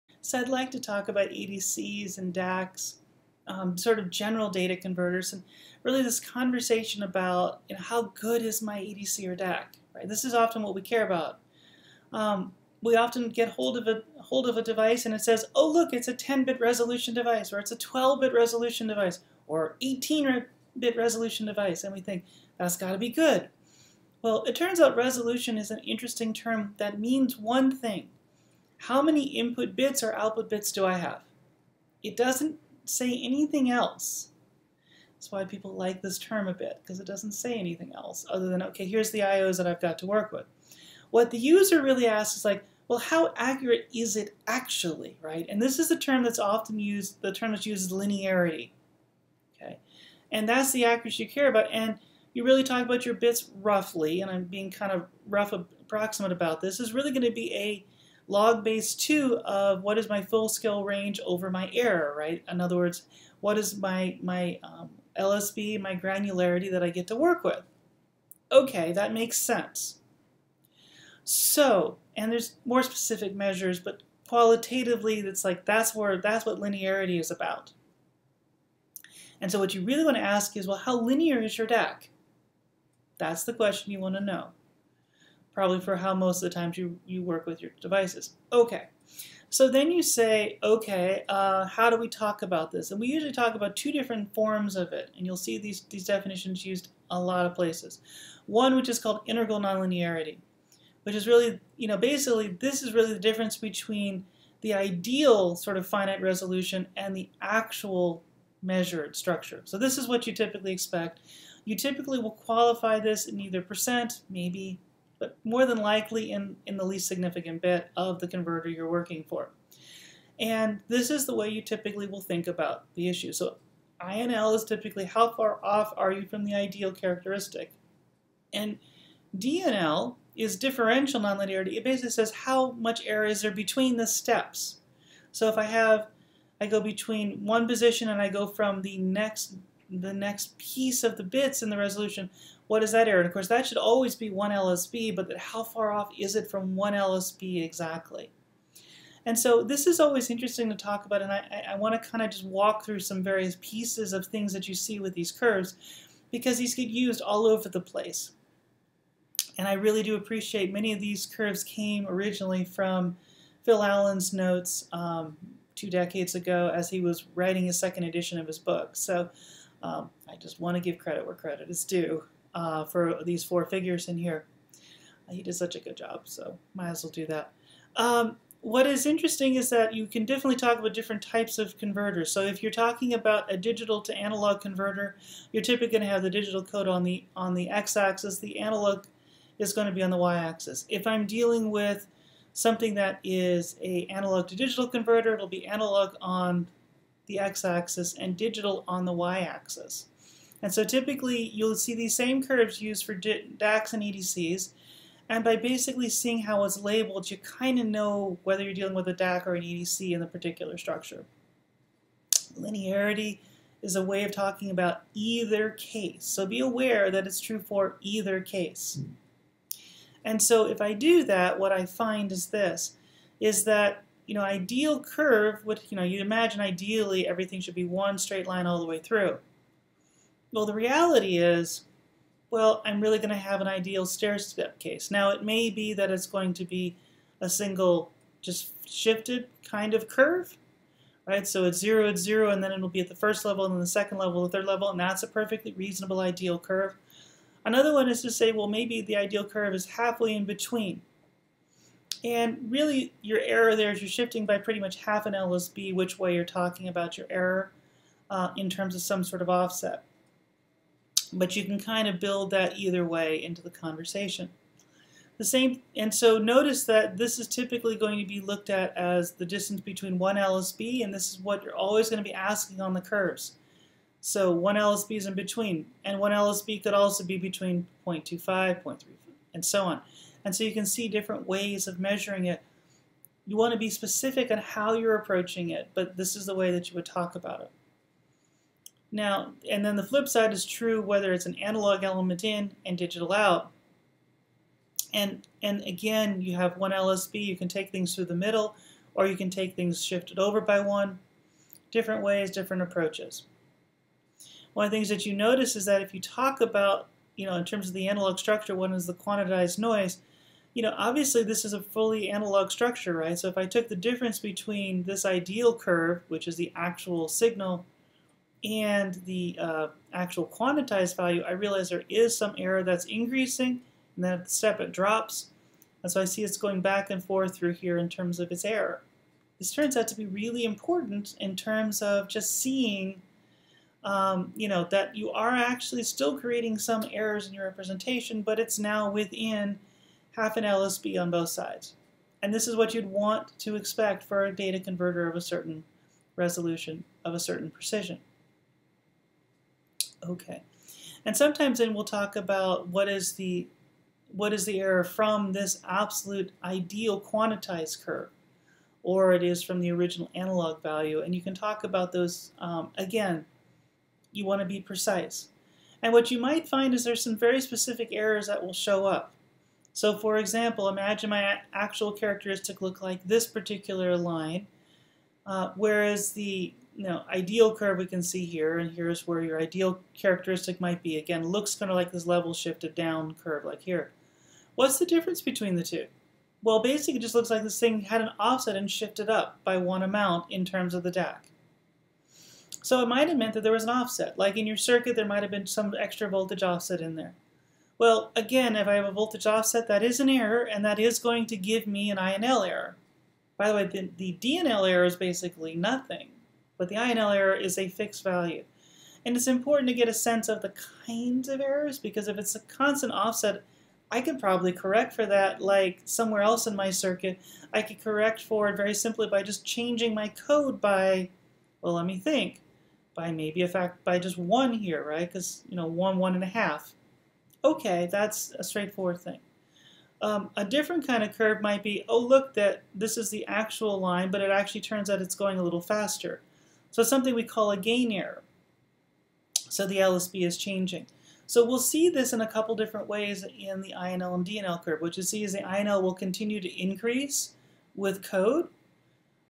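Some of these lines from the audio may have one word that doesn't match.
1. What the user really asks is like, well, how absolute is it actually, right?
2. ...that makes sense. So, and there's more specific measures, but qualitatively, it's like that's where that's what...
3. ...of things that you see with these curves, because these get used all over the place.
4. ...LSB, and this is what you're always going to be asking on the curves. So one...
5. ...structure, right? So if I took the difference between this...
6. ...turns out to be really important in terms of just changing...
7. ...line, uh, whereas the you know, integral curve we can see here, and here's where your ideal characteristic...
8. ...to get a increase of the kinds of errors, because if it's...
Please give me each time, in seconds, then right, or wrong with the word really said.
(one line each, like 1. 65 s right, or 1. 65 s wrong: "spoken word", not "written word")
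1. 41 s wrong: "accurate", not "absolute"
2. 68 s right
3. 154 s right
4. 270 s right
5. 312 s right
6. 329 s wrong: "seeing", not "changing"
7. 374 s wrong: "ideal", not "integral"
8. 409 s wrong: "sense", not "increase".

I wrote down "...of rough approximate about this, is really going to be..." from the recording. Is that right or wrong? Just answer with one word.
right.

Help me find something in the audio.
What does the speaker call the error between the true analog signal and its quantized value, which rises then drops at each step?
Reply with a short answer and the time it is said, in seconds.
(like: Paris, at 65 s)
Quantitized noise, at 309 s.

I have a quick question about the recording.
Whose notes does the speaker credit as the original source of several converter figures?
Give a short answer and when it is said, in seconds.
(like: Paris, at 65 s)
Phil Allen, at 163 s.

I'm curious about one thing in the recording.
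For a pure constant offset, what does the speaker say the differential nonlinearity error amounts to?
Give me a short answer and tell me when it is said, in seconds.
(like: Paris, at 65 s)
Basically nothing, at 405 s.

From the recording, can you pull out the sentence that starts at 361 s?
And you can talk about those, um, again, you want to be precise.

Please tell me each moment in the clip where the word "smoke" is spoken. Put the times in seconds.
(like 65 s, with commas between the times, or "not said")
not said.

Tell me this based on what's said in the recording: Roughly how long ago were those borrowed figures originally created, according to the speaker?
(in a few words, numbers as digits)
Two decades ago.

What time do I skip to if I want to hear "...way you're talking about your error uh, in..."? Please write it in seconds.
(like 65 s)
256 s.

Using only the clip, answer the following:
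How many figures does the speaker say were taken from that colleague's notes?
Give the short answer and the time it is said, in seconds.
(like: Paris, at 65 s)
4, at 173 s.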